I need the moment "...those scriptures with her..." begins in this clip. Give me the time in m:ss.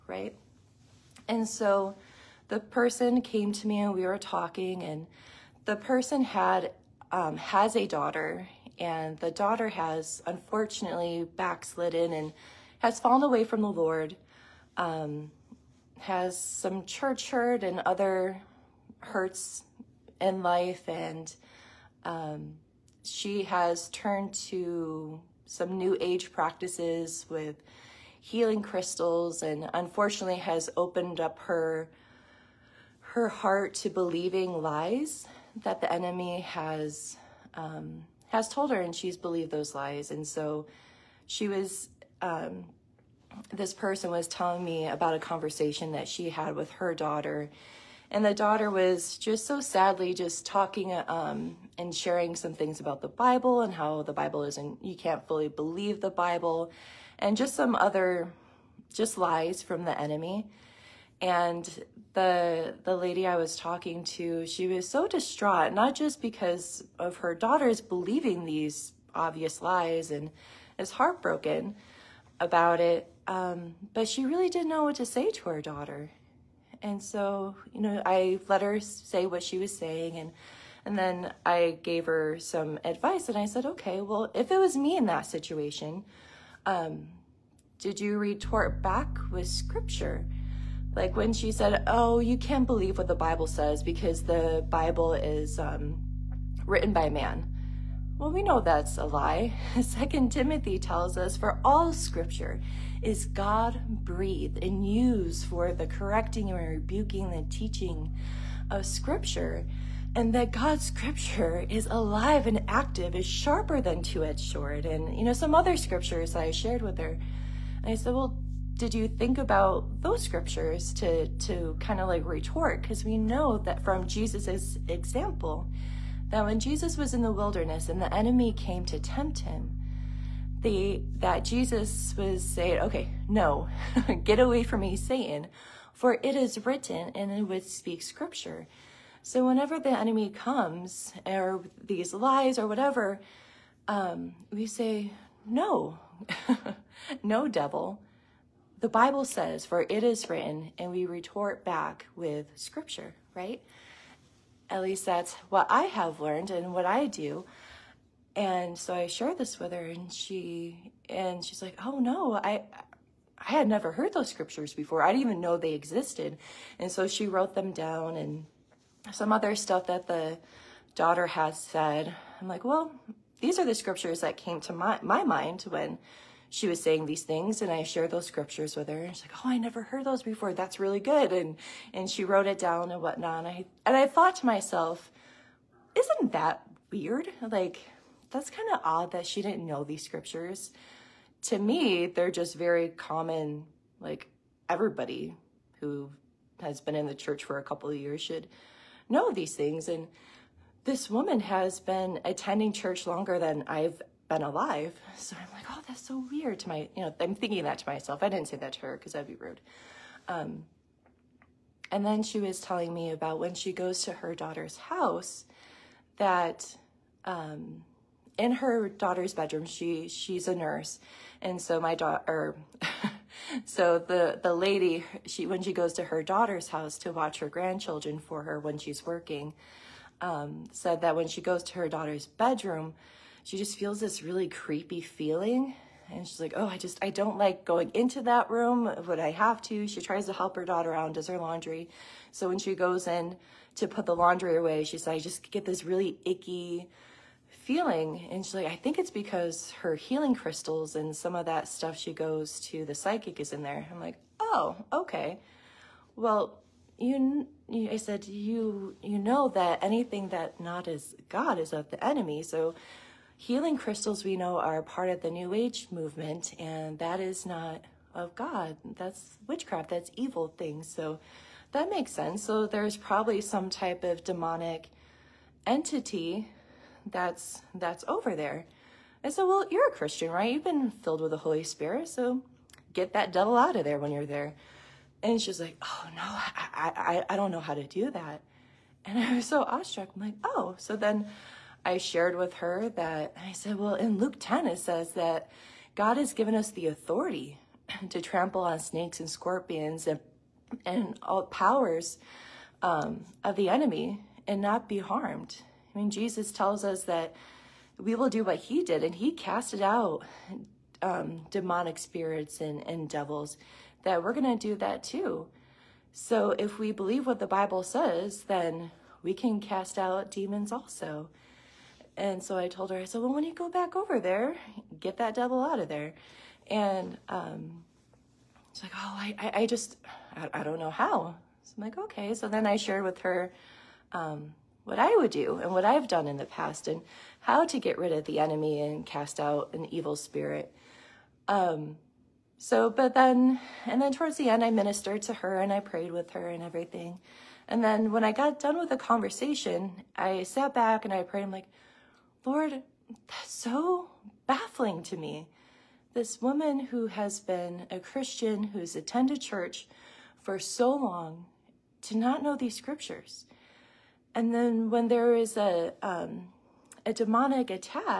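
2:58.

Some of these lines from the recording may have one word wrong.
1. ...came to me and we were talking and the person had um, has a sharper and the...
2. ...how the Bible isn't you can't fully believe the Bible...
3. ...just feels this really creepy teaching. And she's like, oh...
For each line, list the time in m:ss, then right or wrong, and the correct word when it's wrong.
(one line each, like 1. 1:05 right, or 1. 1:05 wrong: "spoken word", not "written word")
1. 0:03 wrong: "daughter", not "sharper"
2. 0:53 right
3. 3:53 wrong: "feeling", not "teaching".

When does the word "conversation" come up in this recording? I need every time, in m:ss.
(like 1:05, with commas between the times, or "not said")
0:45, 5:48.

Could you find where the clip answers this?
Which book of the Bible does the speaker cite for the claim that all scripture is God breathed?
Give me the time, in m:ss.
1:39.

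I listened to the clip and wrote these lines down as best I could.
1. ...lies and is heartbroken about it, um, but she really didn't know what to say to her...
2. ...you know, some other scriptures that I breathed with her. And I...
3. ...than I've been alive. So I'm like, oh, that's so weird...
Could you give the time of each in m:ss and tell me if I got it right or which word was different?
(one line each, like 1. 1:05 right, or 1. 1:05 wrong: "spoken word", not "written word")
1. 1:09 right
2. 1:55 wrong: "shared", not "breathed"
3. 3:23 right.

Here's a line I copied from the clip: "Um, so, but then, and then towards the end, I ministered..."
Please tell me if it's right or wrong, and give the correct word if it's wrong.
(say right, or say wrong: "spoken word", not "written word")
right.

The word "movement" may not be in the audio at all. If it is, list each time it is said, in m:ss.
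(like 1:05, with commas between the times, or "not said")
4:25.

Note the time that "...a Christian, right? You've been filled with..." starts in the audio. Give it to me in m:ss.
4:39.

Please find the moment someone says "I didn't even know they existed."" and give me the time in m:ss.
2:45.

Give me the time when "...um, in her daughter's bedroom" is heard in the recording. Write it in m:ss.
3:37.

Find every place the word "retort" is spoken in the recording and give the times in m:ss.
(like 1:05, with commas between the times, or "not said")
1:28, 2:02, 2:31.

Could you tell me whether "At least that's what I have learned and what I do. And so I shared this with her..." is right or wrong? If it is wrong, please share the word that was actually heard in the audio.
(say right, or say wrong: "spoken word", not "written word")
right.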